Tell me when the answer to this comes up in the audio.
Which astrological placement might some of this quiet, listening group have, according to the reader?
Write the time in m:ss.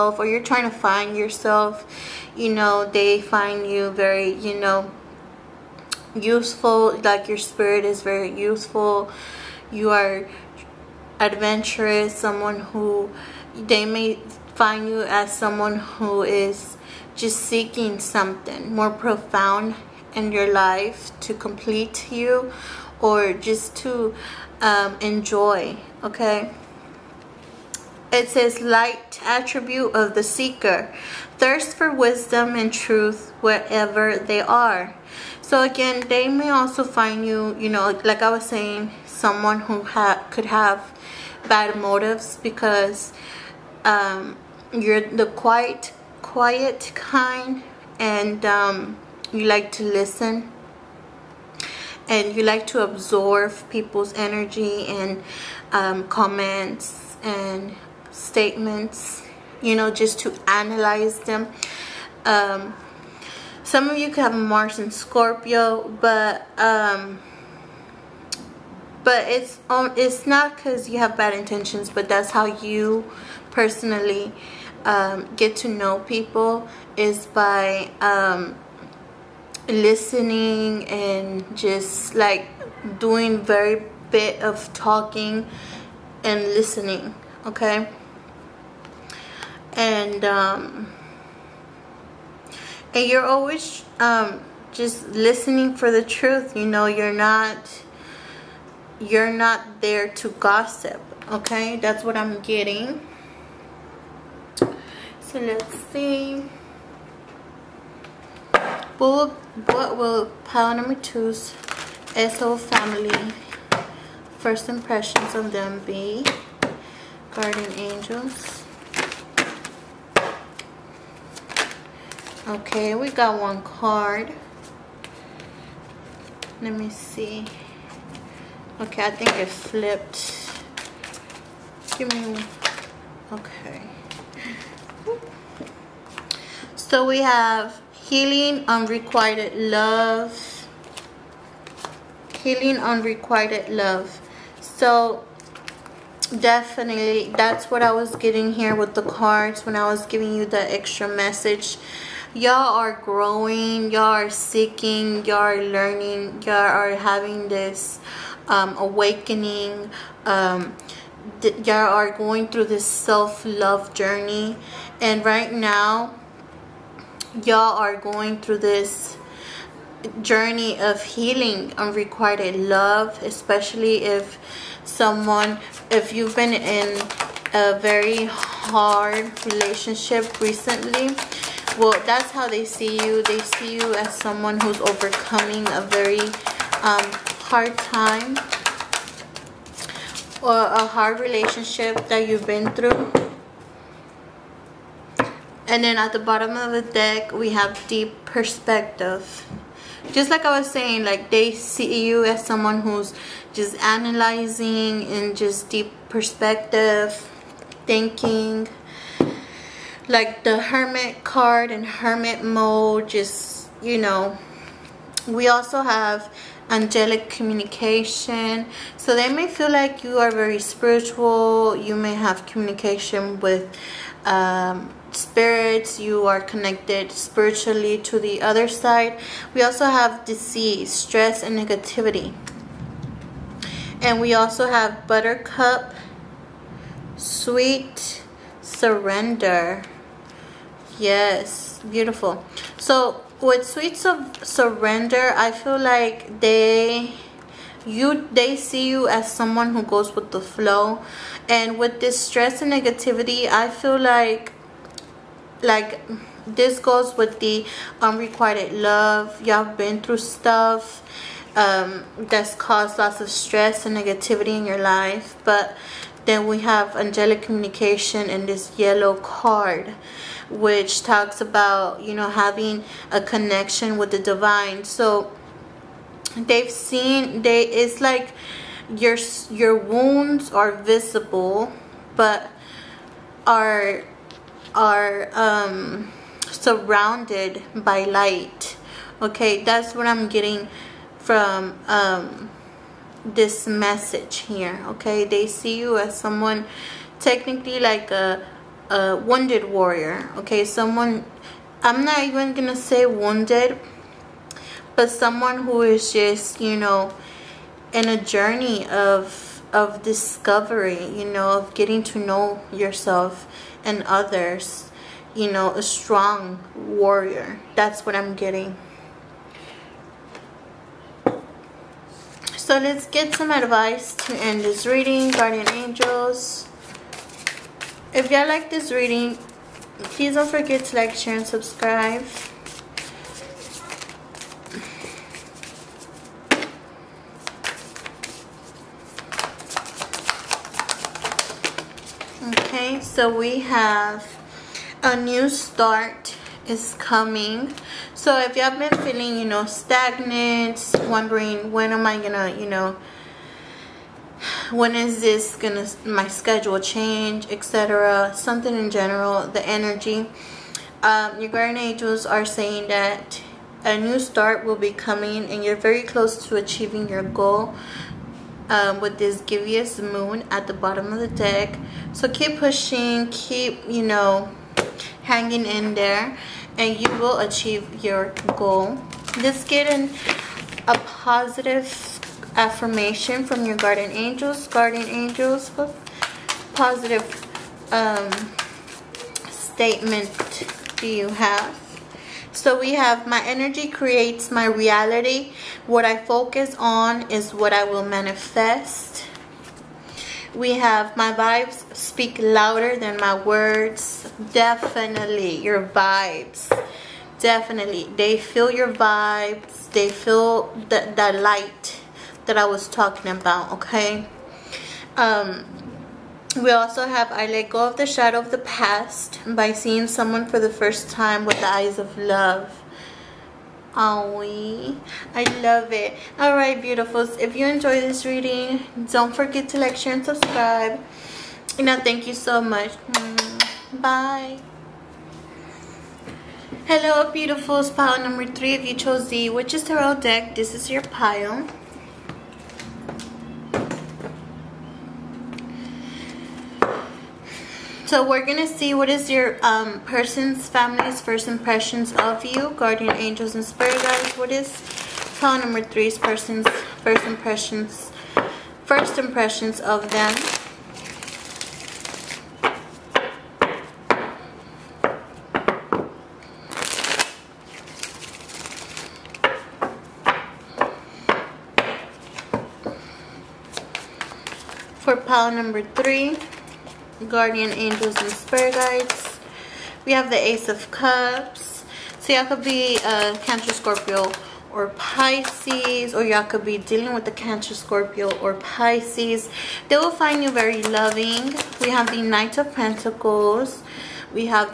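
1:04.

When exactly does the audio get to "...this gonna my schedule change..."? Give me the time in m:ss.
5:55.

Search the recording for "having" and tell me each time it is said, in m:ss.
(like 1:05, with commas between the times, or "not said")
2:36, 4:32.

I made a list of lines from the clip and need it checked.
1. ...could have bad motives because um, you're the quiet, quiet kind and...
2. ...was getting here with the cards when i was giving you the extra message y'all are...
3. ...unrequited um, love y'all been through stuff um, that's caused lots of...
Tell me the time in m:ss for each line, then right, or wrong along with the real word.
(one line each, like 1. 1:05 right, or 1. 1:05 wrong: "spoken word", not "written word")
1. 0:40 right
2. 2:27 right
3. 4:18 right.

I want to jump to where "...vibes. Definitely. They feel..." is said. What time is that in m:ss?
6:45.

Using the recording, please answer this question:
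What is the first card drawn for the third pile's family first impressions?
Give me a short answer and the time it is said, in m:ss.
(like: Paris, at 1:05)
Ace of Cups, at 8:00.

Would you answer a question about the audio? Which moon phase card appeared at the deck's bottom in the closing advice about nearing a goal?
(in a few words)
Gibbous Moon.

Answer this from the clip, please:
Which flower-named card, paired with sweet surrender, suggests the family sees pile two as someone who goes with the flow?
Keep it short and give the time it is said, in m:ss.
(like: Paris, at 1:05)
Buttercup, at 3:55.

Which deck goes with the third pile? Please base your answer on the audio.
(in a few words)
Witches Tarot.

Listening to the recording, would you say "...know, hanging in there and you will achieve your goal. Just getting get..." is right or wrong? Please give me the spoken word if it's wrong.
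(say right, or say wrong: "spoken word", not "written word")
right.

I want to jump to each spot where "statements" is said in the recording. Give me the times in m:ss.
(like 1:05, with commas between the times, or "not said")
0:58, 6:29.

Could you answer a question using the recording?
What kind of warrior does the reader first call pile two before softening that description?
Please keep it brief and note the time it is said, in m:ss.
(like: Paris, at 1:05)
Wounded warrior, at 4:59.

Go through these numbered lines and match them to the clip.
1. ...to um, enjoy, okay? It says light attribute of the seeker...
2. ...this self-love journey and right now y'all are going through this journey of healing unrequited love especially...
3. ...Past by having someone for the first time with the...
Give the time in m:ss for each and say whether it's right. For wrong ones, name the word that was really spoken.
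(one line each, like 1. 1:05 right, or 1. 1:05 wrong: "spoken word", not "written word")
1. 0:23 right
2. 2:42 right
3. 6:58 wrong: "seeing", not "having".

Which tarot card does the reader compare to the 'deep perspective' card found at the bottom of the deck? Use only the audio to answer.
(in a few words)
The Hermit.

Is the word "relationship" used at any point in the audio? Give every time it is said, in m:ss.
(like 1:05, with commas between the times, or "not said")
2:59, 3:11.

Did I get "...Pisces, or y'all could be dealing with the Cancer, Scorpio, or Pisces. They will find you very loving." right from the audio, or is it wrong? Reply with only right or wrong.
right.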